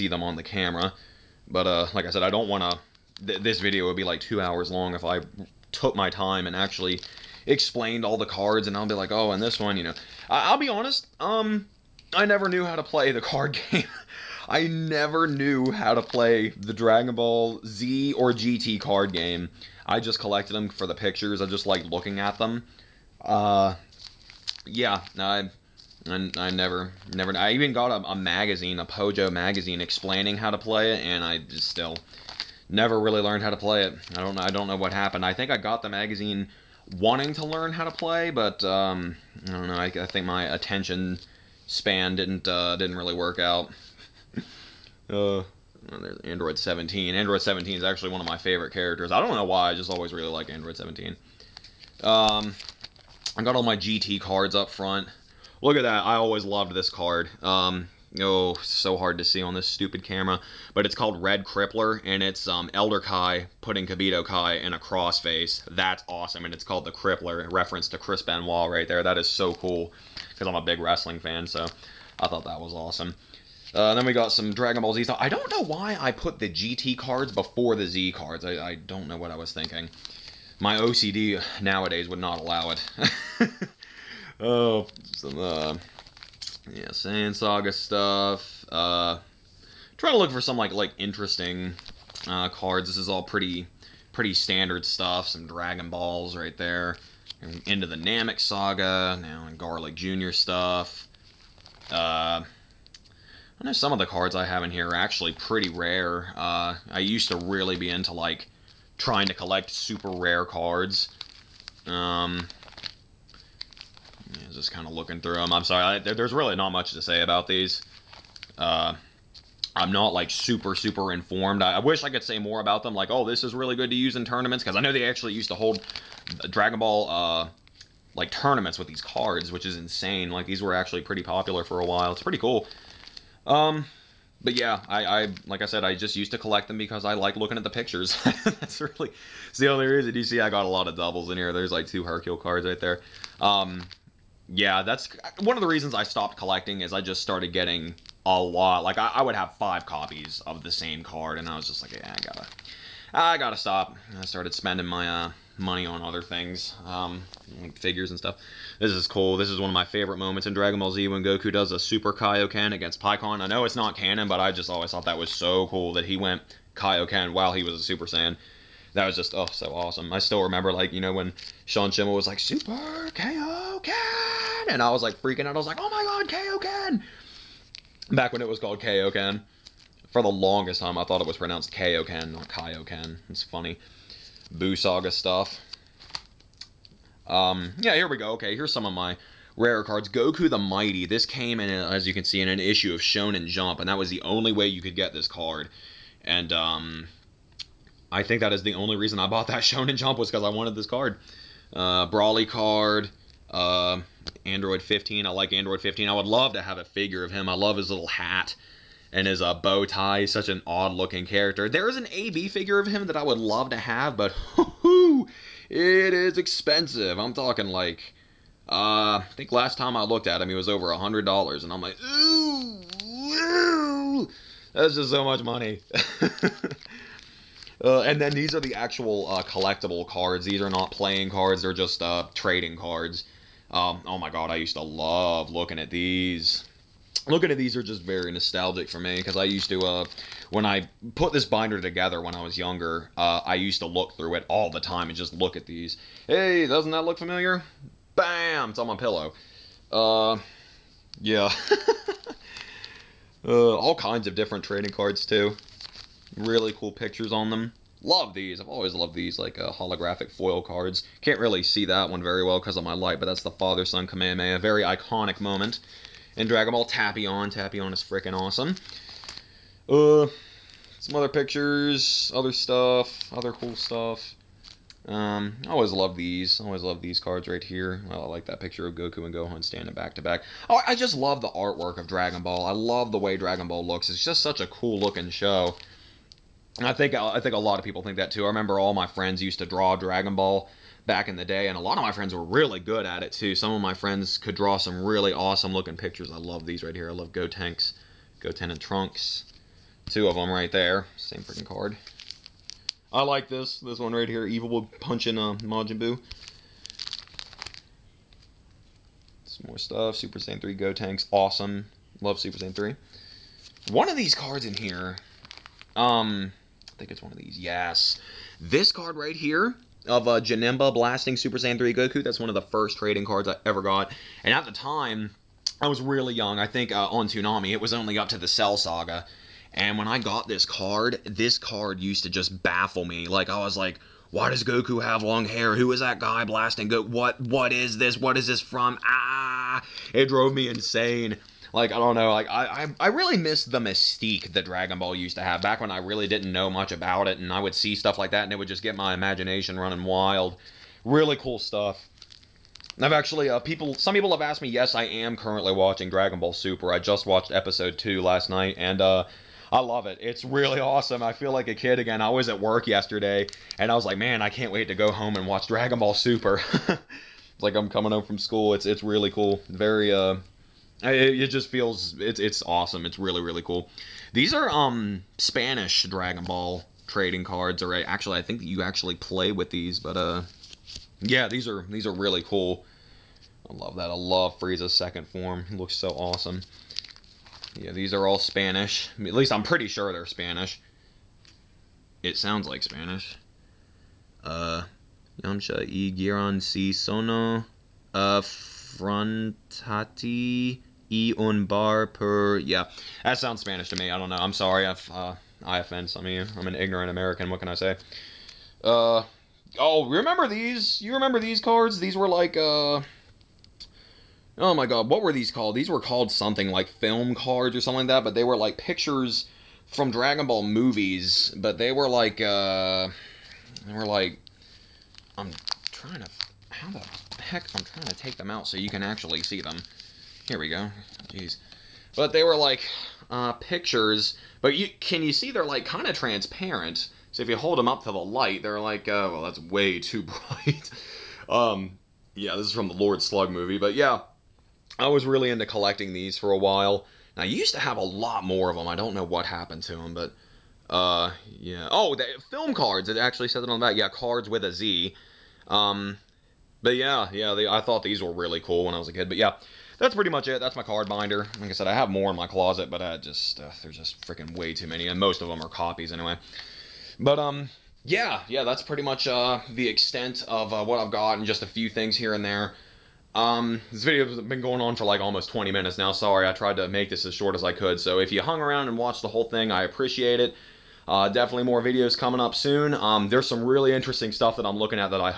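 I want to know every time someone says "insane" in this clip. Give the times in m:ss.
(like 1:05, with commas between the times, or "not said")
2:09, 5:40.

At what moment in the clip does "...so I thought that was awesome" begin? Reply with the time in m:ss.
1:11.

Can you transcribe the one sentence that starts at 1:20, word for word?
My OCD nowadays would not allow it.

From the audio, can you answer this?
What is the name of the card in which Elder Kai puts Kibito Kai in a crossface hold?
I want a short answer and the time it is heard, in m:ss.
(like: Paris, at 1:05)
Red Crippler, at 1:01.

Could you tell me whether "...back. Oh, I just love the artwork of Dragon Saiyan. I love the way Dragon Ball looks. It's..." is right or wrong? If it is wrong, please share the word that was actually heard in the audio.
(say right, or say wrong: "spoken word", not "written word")
wrong: "Ball", not "Saiyan".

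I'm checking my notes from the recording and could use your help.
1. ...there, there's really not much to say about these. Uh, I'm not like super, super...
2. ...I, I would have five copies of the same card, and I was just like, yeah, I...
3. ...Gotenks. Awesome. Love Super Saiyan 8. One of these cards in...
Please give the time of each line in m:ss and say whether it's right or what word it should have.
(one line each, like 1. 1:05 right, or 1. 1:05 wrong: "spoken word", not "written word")
1. 1:55 right
2. 2:28 right
3. 5:10 wrong: "3", not "8".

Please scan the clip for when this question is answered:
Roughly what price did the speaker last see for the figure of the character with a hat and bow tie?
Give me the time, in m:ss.
3:40.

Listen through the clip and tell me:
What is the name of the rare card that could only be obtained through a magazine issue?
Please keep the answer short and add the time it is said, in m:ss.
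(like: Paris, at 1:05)
Goku the Mighty, at 3:10.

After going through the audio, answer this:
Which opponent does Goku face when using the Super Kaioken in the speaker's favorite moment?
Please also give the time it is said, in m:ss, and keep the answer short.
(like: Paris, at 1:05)
Pikkon, at 2:42.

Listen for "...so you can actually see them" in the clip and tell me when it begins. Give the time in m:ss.
7:08.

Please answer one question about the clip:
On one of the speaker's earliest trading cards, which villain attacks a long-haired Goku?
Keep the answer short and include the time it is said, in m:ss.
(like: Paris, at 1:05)
Janemba, at 5:20.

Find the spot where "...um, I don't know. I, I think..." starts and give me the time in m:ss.
0:38.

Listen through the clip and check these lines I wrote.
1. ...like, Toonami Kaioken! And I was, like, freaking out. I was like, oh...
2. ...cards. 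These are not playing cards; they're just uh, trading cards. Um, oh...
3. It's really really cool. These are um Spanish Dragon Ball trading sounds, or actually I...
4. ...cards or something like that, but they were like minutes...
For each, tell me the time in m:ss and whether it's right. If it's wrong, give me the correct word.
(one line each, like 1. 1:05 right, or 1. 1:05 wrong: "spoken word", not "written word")
1. 2:52 wrong: "Super", not "Toonami"
2. 3:50 right
3. 6:13 wrong: "cards", not "sounds"
4. 6:57 wrong: "pictures", not "minutes".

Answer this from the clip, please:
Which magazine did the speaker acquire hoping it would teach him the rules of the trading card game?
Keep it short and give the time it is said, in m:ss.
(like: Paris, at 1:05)
Pojo, at 0:28.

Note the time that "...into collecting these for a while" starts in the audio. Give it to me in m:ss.
7:25.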